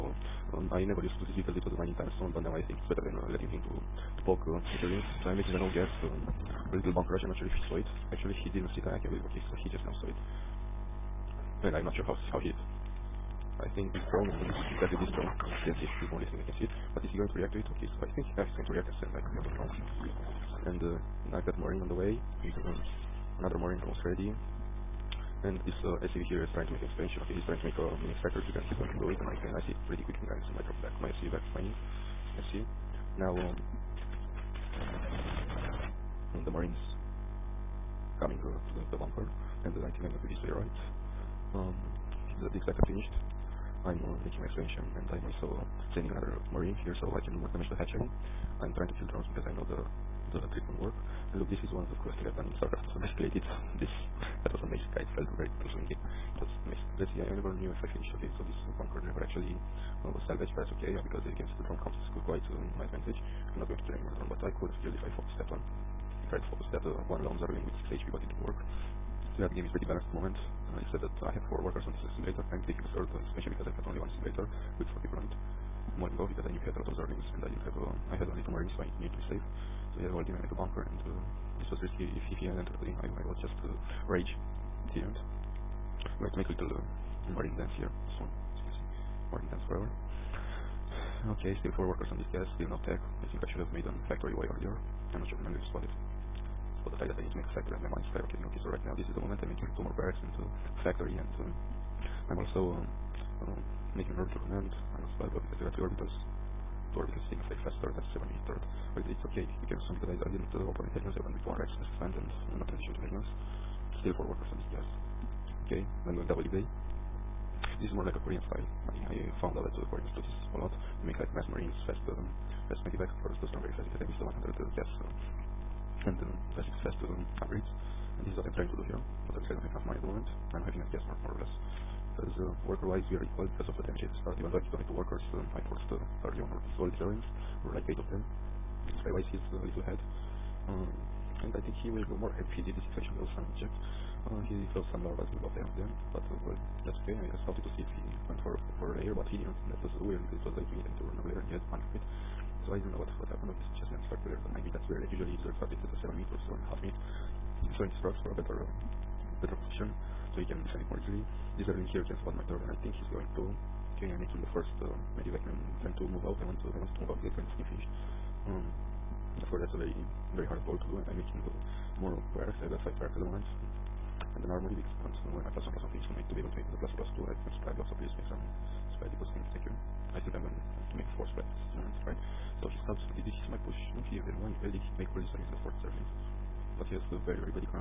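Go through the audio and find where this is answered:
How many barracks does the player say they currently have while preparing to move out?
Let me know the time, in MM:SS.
02:52.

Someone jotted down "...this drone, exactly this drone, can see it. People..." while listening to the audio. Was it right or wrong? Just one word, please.
right.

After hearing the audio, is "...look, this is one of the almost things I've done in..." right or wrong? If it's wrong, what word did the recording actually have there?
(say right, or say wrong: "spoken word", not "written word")
wrong: "coolest", not "almost".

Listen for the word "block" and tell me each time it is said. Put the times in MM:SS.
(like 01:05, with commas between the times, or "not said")
01:45, 02:57.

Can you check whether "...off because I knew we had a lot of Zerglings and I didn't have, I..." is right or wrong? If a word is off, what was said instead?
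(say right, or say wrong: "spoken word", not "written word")
right.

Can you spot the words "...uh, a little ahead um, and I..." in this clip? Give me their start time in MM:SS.
02:19.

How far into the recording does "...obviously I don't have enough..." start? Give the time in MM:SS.
02:09.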